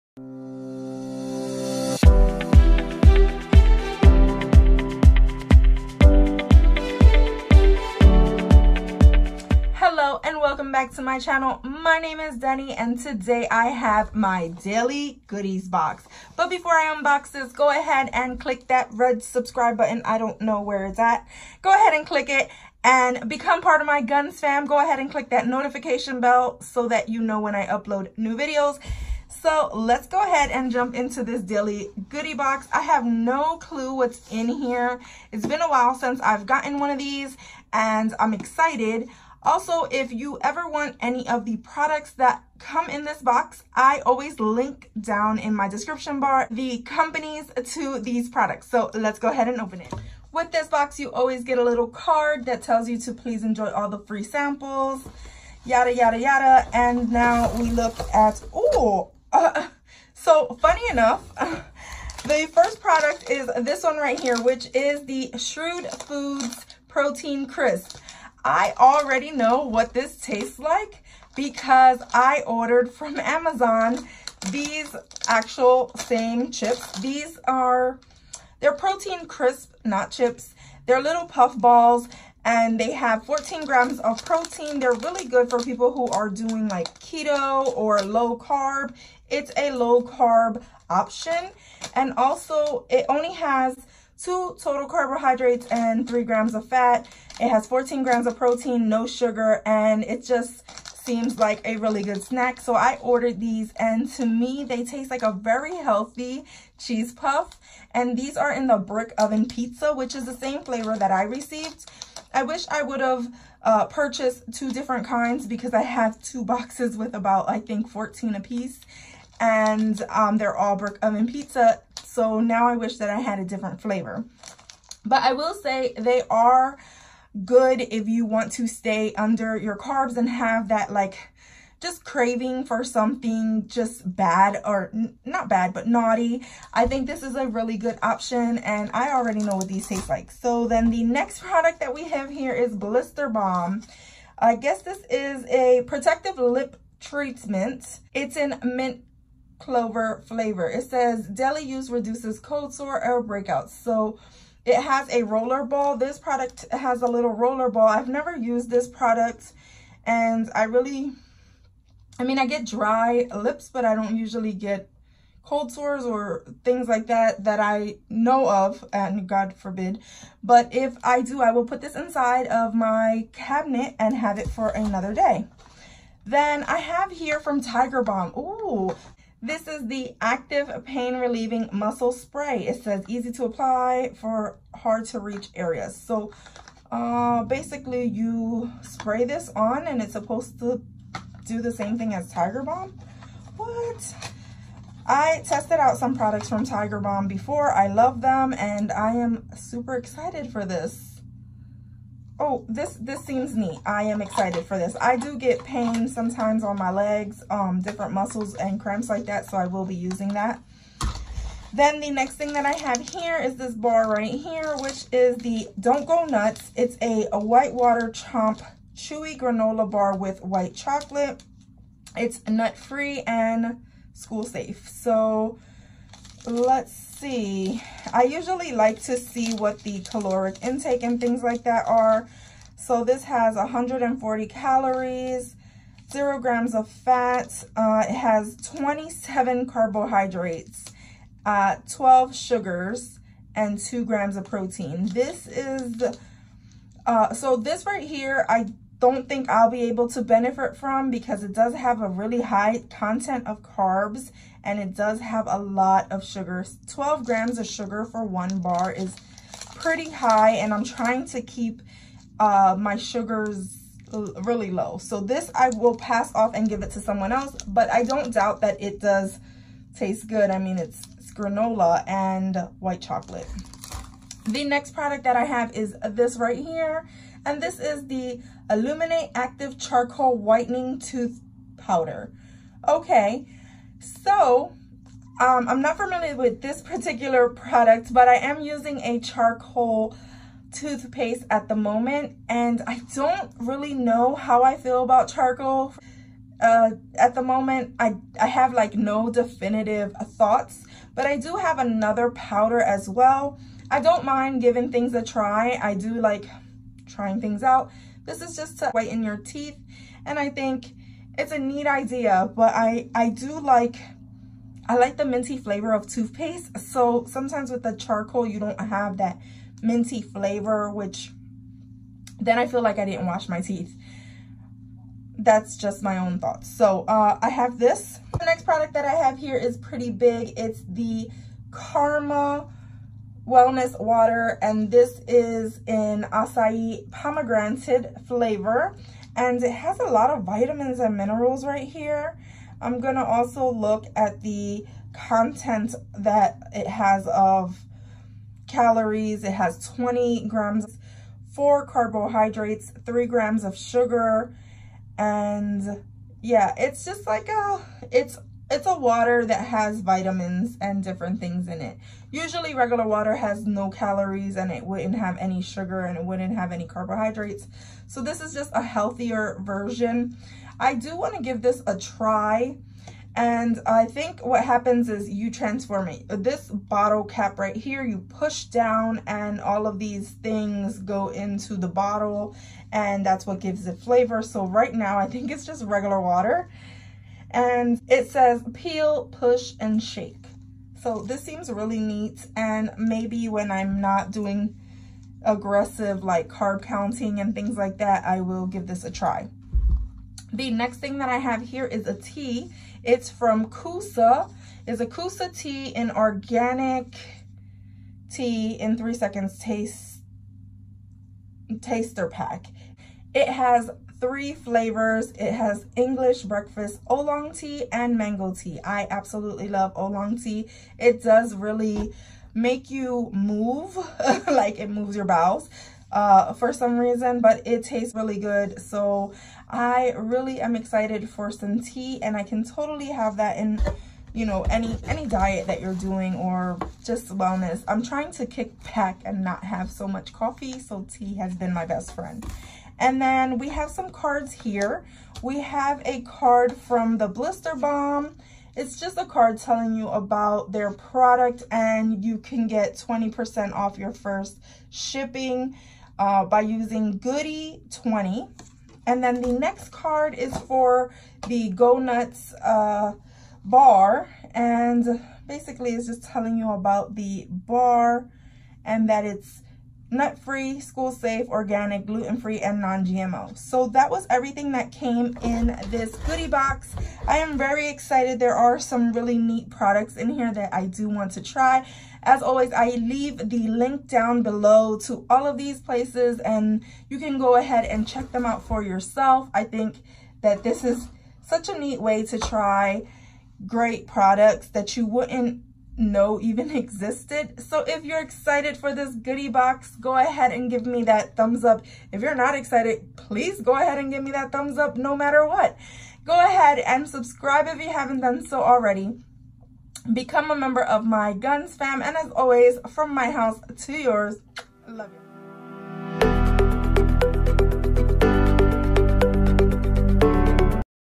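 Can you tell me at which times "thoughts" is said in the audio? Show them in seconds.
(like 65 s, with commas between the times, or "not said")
300 s, 326 s.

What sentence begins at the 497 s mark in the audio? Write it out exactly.
So if you're excited for this goodie box, go ahead and give me that thumbs up.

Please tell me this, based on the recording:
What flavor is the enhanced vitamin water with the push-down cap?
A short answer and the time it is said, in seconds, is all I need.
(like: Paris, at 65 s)
Acai pomegranate, at 336 s.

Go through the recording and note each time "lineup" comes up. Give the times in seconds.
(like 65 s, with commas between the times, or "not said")
not said.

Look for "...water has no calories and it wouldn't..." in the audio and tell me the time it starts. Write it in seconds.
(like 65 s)
363 s.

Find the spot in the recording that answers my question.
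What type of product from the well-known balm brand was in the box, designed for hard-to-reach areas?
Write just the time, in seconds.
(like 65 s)
181 s.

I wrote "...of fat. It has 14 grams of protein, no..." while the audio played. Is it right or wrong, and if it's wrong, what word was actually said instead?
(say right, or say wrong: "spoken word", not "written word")
right.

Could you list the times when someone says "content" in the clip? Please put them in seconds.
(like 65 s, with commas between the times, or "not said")
252 s, 345 s.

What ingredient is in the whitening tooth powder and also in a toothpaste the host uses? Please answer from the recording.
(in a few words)
Active charcoal.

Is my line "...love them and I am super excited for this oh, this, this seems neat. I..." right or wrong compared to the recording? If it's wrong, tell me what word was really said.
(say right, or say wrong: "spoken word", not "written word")
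right.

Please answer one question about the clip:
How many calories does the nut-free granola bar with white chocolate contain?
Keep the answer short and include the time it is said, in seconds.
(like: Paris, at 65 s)
140, at 233 s.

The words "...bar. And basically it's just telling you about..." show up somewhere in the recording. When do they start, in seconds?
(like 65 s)
463 s.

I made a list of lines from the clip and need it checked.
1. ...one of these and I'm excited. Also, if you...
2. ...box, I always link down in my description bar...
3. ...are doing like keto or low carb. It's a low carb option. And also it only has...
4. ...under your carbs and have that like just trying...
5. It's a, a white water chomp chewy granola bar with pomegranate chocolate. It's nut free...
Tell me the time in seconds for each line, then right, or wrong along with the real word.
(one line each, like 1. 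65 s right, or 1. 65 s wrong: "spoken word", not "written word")
1. 36 s right
2. 43 s right
3. 86 s right
4. 129 s wrong: "craving", not "trying"
5. 216 s wrong: "white", not "pomegranate".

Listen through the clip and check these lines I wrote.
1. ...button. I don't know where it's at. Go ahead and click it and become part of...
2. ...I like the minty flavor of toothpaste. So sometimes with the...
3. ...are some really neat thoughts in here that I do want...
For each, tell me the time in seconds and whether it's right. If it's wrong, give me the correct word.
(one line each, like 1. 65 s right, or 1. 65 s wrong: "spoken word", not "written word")
1. 19 s right
2. 314 s right
3. 478 s wrong: "products", not "thoughts".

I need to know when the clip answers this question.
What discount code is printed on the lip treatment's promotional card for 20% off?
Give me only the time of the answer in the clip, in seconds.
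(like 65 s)
457 s.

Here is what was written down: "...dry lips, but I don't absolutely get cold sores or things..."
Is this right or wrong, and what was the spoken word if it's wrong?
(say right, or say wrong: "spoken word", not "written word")
wrong: "usually", not "absolutely".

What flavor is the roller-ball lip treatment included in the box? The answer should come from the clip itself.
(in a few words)
Mint clover.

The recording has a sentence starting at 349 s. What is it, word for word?
It has 20 grams, four carbohydrates, three grams of sugar.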